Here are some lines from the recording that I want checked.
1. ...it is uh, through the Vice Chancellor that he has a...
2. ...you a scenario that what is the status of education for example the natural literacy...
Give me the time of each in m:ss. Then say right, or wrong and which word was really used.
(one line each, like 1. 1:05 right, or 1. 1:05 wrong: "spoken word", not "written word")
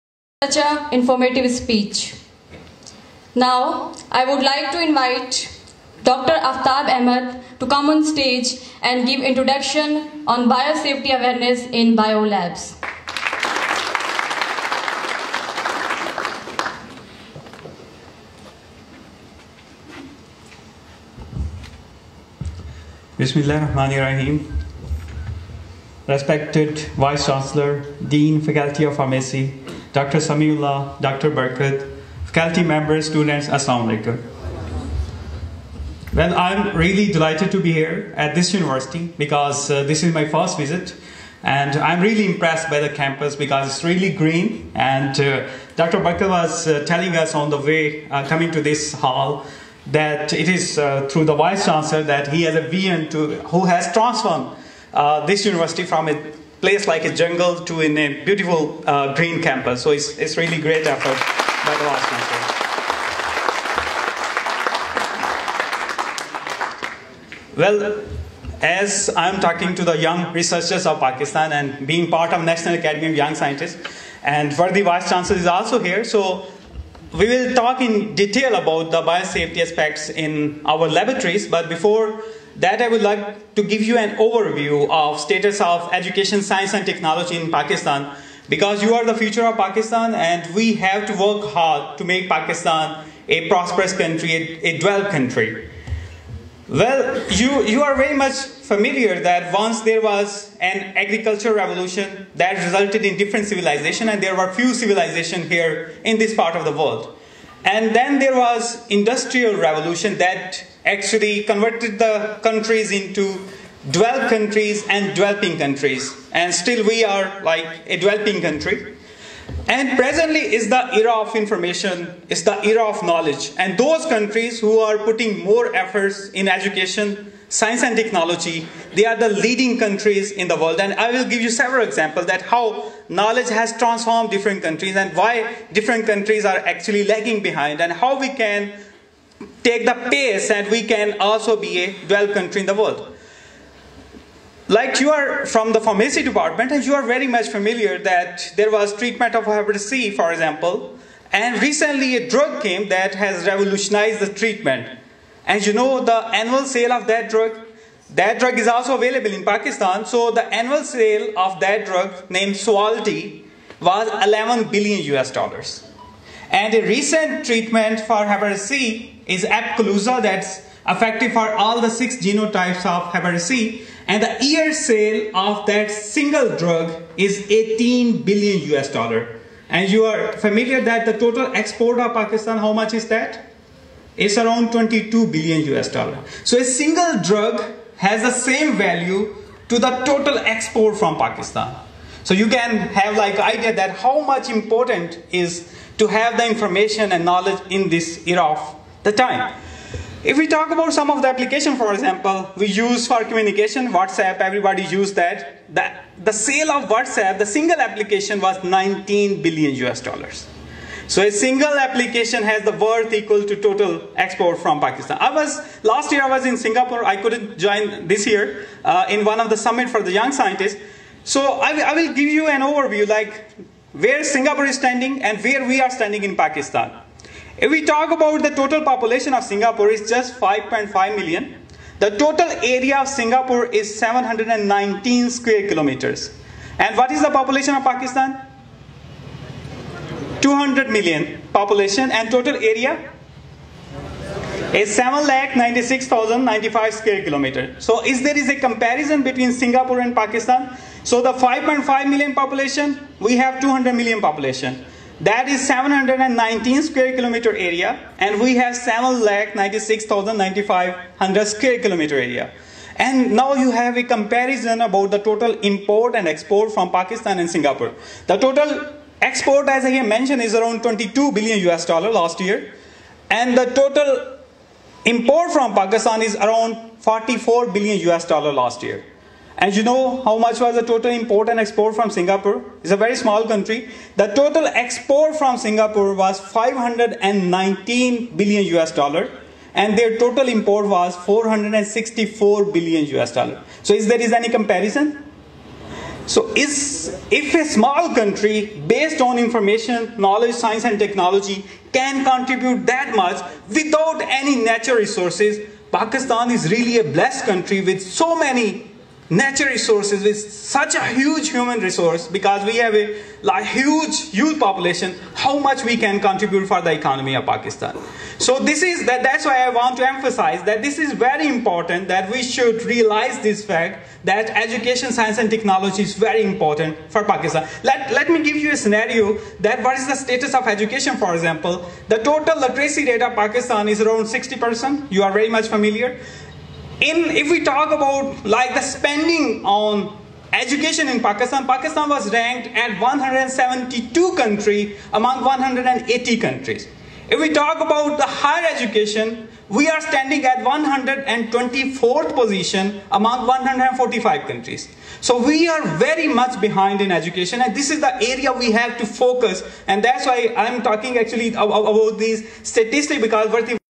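1. 0:50 right
2. 5:28 wrong: "total", not "natural".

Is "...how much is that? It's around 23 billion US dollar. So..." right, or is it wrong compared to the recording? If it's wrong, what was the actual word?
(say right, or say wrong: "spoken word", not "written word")
wrong: "22", not "23".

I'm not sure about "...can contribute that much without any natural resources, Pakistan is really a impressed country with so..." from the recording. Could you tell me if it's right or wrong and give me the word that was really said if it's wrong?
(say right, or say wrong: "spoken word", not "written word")
wrong: "blessed", not "impressed".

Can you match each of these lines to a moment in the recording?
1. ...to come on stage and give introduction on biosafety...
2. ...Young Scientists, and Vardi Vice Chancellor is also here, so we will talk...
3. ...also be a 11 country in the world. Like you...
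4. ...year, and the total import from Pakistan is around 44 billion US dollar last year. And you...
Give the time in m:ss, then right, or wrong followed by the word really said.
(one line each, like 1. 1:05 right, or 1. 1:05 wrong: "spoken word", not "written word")
1. 0:07 right
2. 1:13 right
3. 2:21 wrong: "12", not "11"
4. 4:32 right.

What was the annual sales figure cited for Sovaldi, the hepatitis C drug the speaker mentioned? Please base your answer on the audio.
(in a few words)
$11 billion.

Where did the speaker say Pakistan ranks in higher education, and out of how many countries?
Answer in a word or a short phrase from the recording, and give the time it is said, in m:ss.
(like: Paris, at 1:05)
124th of 145, at 5:50.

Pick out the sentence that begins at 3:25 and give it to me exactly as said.
The, the sale of WhatsApp, the single application was 19 billion US dollars.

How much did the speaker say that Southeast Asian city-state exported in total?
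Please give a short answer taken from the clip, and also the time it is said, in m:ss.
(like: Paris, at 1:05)
$519 billion, at 4:46.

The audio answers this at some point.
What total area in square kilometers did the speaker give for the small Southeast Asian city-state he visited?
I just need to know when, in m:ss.
3:53.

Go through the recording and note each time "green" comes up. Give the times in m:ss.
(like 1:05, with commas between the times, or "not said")
0:44, 0:59.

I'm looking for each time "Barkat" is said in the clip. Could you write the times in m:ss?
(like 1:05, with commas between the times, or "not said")
0:31, 0:45.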